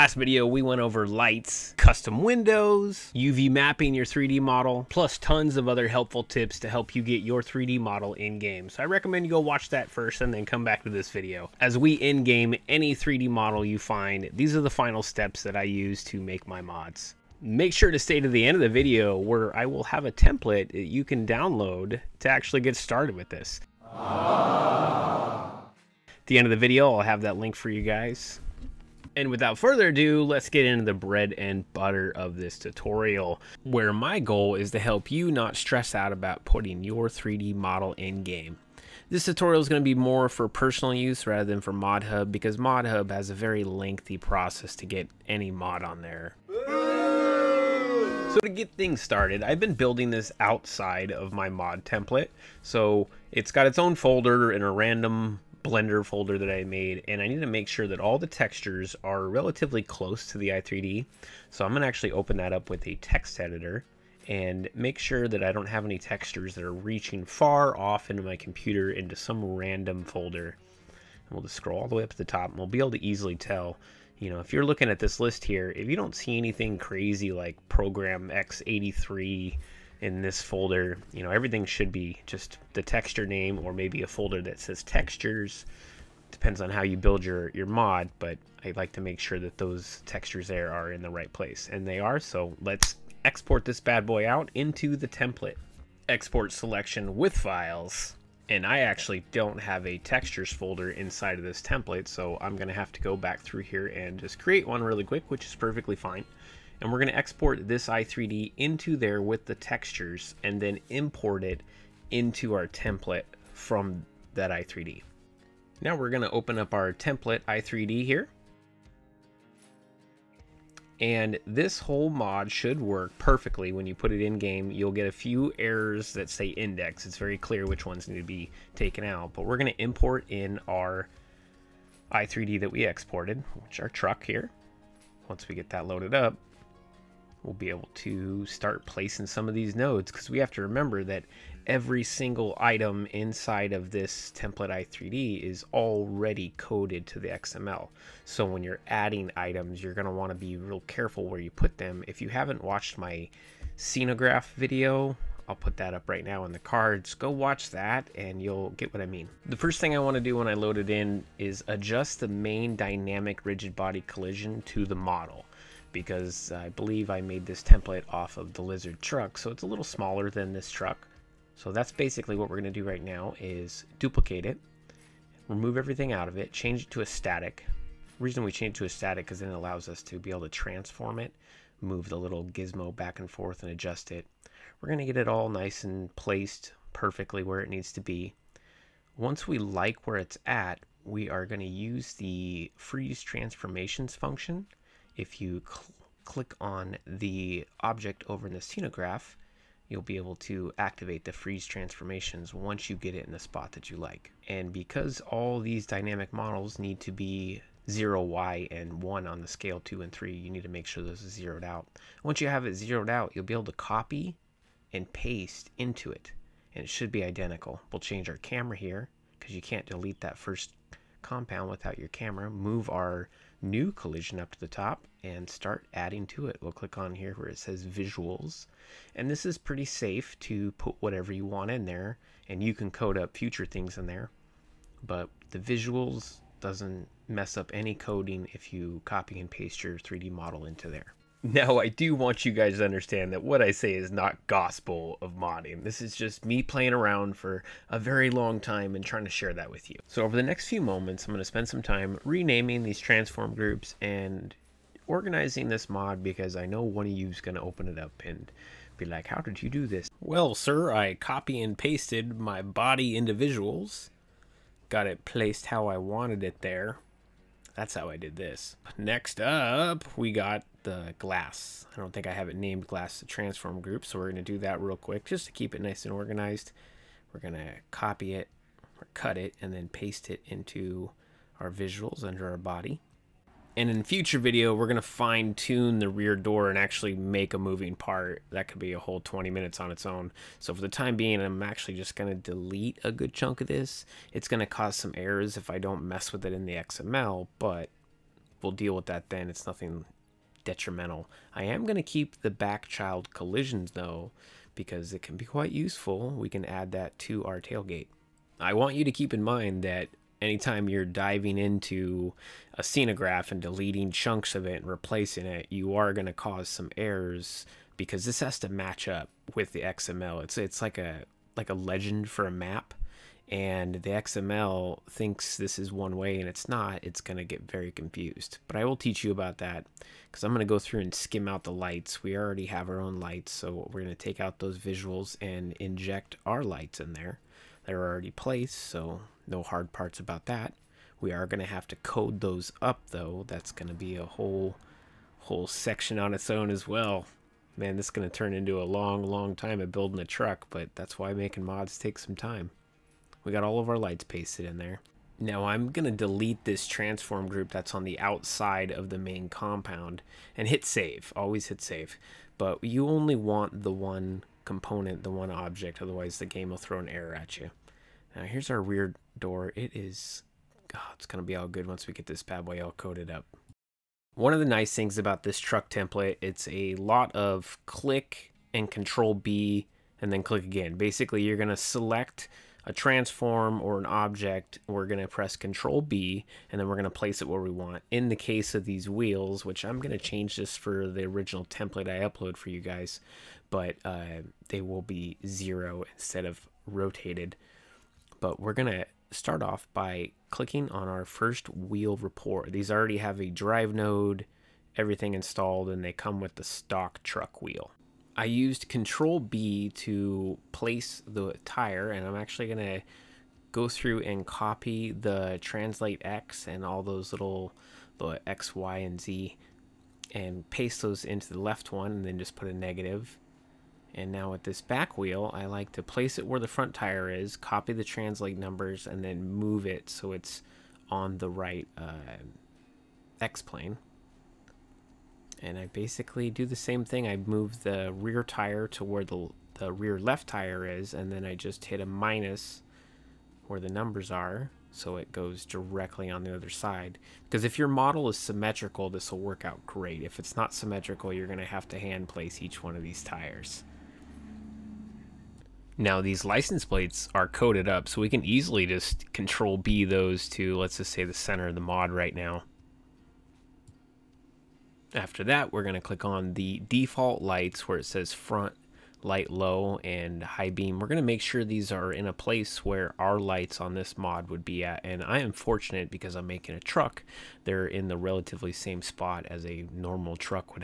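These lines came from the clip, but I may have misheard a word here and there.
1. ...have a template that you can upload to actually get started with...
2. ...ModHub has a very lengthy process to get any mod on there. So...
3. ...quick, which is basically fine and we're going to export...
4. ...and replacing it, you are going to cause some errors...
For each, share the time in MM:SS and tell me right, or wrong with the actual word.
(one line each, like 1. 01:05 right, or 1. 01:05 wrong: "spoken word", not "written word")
1. 00:19 wrong: "download", not "upload"
2. 00:42 right
3. 01:45 wrong: "perfectly", not "basically"
4. 05:14 right.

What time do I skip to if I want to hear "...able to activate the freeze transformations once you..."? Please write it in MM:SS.
03:20.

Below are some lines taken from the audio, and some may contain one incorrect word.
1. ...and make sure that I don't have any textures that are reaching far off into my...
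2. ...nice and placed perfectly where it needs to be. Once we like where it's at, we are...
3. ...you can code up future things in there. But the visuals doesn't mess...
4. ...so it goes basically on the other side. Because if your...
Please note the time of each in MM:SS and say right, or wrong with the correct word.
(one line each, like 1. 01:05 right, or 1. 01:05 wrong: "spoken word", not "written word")
1. 01:04 right
2. 03:05 right
3. 03:52 right
4. 07:24 wrong: "directly", not "basically".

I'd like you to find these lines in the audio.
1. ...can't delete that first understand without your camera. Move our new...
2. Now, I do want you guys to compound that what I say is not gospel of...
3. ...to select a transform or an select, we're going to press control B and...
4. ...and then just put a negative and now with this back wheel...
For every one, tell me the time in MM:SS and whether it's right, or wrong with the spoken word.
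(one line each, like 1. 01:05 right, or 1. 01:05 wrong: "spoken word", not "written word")
1. 03:39 wrong: "compound", not "understand"
2. 04:01 wrong: "understand", not "compound"
3. 06:21 wrong: "object", not "select"
4. 07:02 right.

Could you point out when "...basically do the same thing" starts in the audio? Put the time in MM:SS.
07:15.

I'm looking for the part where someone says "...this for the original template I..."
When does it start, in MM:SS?
06:30.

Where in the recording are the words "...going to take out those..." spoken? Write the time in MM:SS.
05:34.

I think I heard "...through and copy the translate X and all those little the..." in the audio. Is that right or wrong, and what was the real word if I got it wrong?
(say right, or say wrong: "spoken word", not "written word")
right.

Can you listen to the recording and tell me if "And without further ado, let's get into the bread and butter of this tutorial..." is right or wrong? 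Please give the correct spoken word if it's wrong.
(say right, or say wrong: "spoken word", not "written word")
right.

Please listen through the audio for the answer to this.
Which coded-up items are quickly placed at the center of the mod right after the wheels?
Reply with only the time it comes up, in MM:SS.
07:36.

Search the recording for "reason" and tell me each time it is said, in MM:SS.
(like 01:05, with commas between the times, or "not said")
02:58.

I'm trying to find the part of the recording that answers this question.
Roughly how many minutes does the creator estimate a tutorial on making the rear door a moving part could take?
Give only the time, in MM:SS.
04:49.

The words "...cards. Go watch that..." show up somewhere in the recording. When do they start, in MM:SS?
02:36.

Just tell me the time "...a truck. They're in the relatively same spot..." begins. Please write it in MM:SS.
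07:56.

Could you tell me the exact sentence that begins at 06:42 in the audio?
These already have a drive node, everything installed, and they come with the stock truck wheel.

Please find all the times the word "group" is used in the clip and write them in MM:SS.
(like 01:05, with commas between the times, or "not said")
04:13, 04:33, 05:57.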